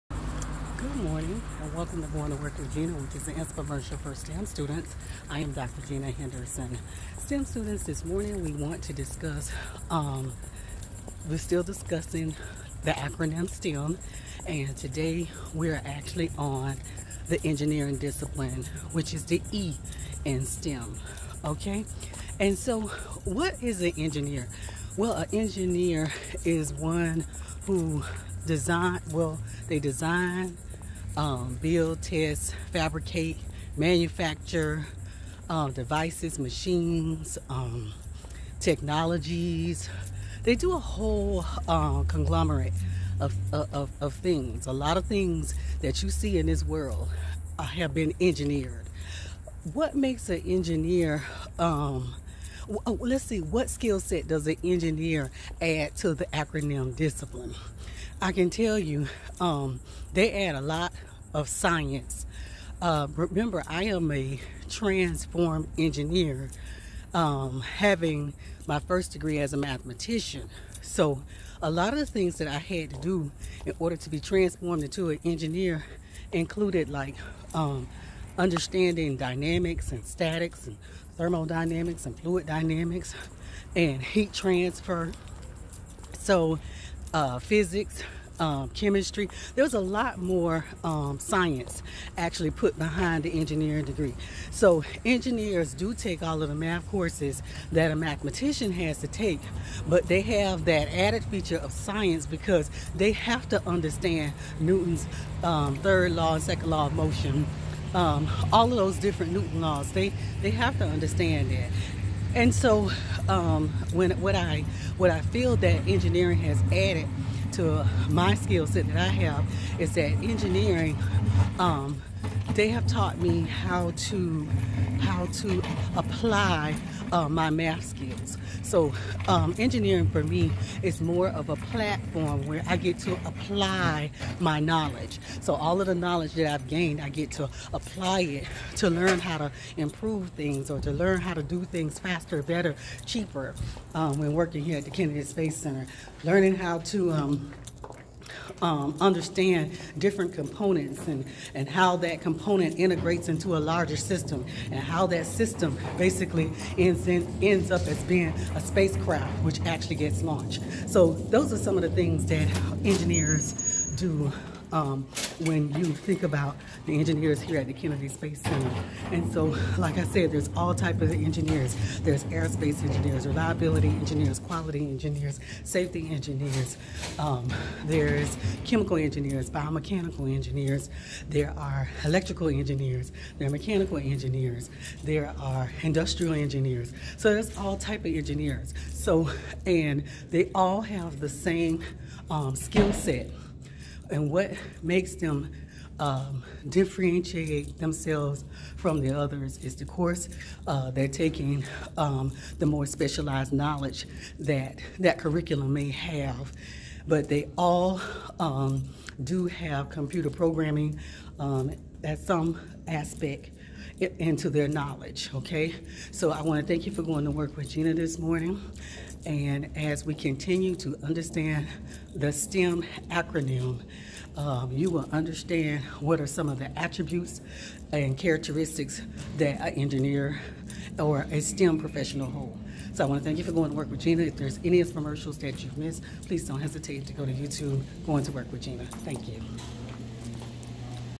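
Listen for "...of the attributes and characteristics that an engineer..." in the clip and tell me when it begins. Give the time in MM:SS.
03:46.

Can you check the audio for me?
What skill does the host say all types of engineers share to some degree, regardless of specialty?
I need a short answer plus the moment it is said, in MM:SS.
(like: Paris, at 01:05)
Computer programming, at 03:29.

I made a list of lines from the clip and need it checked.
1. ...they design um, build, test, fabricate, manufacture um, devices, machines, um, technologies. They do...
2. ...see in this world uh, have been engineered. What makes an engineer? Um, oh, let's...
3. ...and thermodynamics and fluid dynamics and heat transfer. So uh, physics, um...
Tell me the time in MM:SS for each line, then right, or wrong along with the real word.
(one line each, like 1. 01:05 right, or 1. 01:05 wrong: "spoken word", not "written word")
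1. 00:29 right
2. 00:46 right
3. 01:20 right.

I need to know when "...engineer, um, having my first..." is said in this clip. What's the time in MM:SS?
01:05.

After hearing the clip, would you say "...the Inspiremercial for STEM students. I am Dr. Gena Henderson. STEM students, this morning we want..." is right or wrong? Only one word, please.
right.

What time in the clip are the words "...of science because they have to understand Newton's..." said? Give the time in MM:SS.
01:41.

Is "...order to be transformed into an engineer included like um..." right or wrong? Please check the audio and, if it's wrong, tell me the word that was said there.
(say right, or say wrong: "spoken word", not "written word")
right.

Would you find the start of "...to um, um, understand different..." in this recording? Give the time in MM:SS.
02:26.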